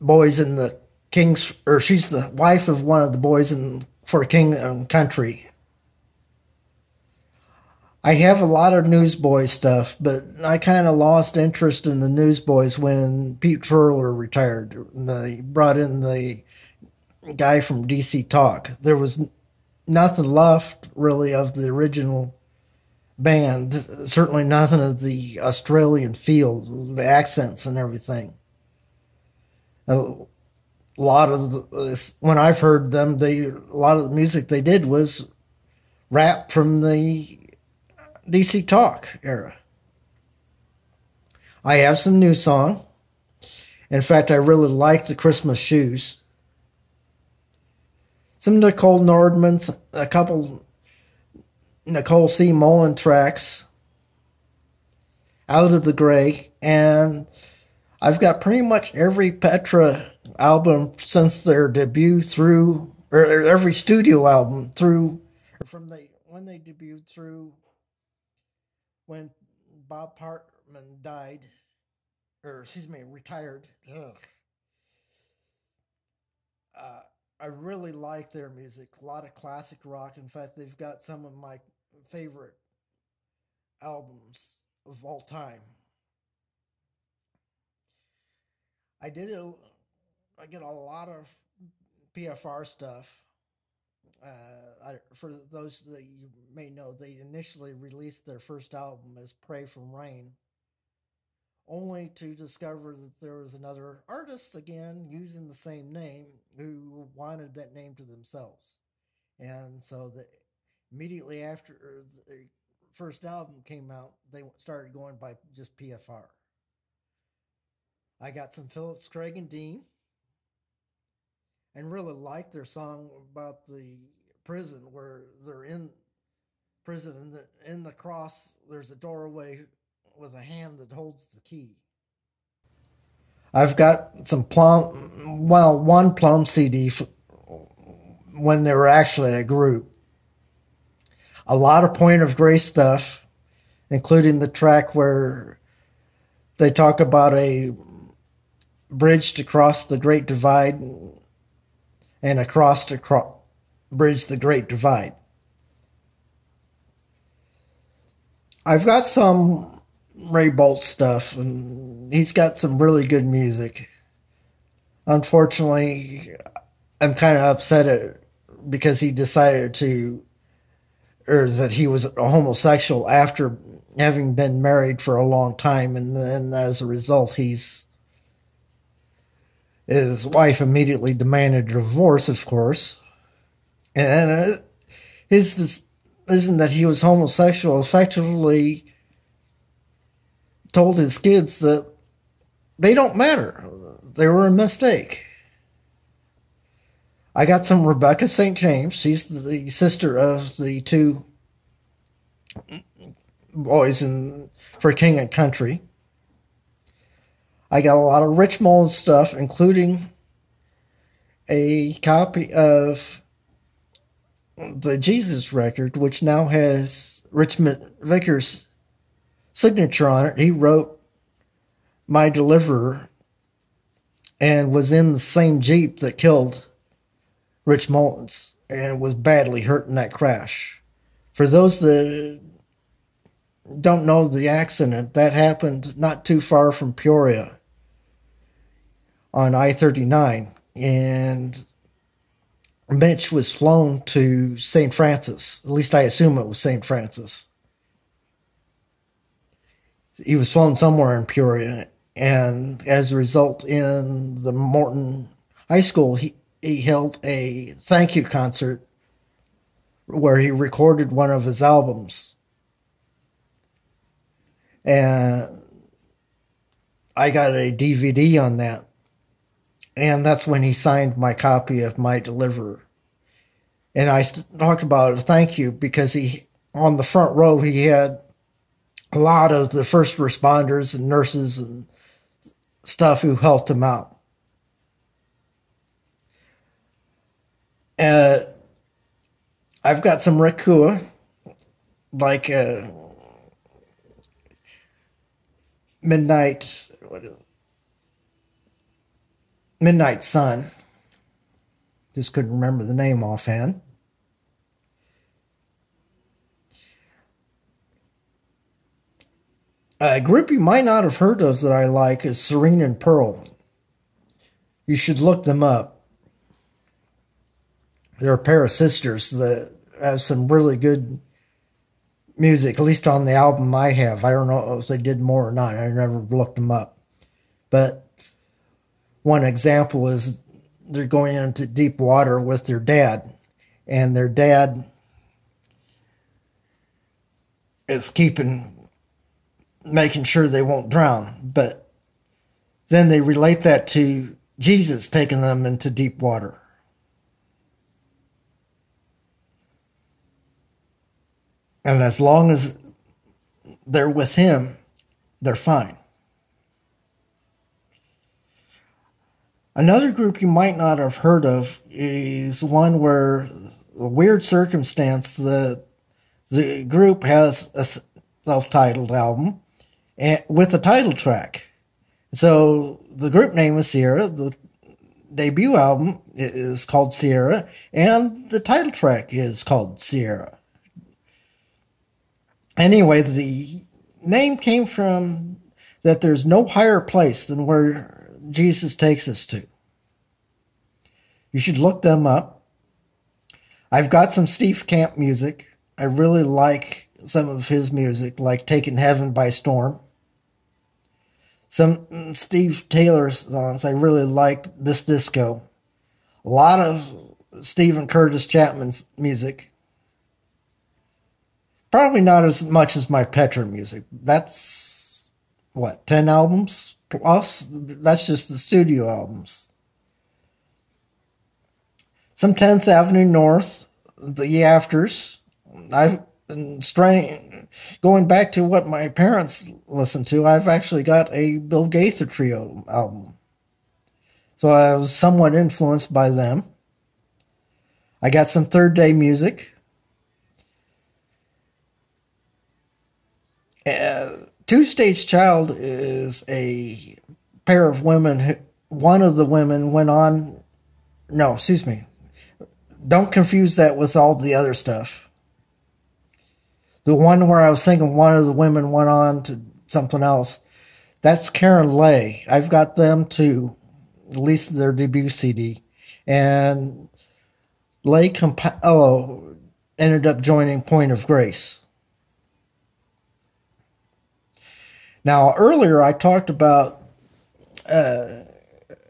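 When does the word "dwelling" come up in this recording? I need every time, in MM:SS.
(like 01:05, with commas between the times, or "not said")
not said.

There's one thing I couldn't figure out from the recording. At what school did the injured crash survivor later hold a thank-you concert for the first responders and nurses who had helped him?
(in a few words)
Morton High School.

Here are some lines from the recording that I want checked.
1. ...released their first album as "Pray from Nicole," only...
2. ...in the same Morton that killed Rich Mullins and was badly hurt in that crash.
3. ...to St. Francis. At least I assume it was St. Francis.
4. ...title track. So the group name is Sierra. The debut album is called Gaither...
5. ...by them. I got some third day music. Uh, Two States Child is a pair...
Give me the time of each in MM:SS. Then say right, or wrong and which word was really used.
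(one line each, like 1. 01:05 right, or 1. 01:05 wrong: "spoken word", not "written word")
1. 01:37 wrong: "Rain", not "Nicole"
2. 03:44 wrong: "Jeep", not "Morton"
3. 04:04 right
4. 06:10 wrong: "Sierra", not "Gaither"
5. 07:16 right.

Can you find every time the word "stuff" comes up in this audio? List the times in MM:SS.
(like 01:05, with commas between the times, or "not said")
00:09, 01:32, 02:22, 02:40, 03:28, 04:42, 07:34.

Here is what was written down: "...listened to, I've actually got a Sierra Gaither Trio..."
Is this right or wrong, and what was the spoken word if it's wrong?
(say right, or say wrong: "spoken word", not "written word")
wrong: "Bill", not "Sierra".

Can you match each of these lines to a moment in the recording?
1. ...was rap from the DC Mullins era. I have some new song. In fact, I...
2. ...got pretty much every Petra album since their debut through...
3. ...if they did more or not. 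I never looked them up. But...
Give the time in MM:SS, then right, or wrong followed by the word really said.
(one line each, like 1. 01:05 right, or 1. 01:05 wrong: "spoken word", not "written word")
1. 00:34 wrong: "Talk", not "Mullins"
2. 00:58 right
3. 05:24 right.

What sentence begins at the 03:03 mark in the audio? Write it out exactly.
And uh, his decision that he was homosexual effectively told his kids that they don't matter.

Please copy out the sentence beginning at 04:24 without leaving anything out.
And I got a DVD on that and that's when he signed my copy of My Deliverer.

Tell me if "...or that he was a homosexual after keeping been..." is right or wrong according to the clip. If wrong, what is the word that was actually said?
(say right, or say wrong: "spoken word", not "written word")
wrong: "having", not "keeping".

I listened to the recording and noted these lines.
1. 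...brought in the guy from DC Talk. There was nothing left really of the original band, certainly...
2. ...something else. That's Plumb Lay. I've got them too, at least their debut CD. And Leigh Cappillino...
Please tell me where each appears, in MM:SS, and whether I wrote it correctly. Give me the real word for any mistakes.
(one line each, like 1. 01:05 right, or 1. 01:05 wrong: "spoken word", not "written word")
1. 00:15 right
2. 07:39 wrong: "Karen", not "Plumb".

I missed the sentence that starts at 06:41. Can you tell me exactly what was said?
Some Steve Taylor songs I really liked, This Disco.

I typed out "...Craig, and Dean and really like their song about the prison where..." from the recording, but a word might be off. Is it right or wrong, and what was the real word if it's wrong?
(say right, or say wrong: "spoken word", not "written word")
right.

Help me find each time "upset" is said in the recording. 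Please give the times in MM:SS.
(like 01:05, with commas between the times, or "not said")
02:47.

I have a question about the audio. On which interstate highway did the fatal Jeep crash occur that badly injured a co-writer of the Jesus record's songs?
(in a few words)
I-39.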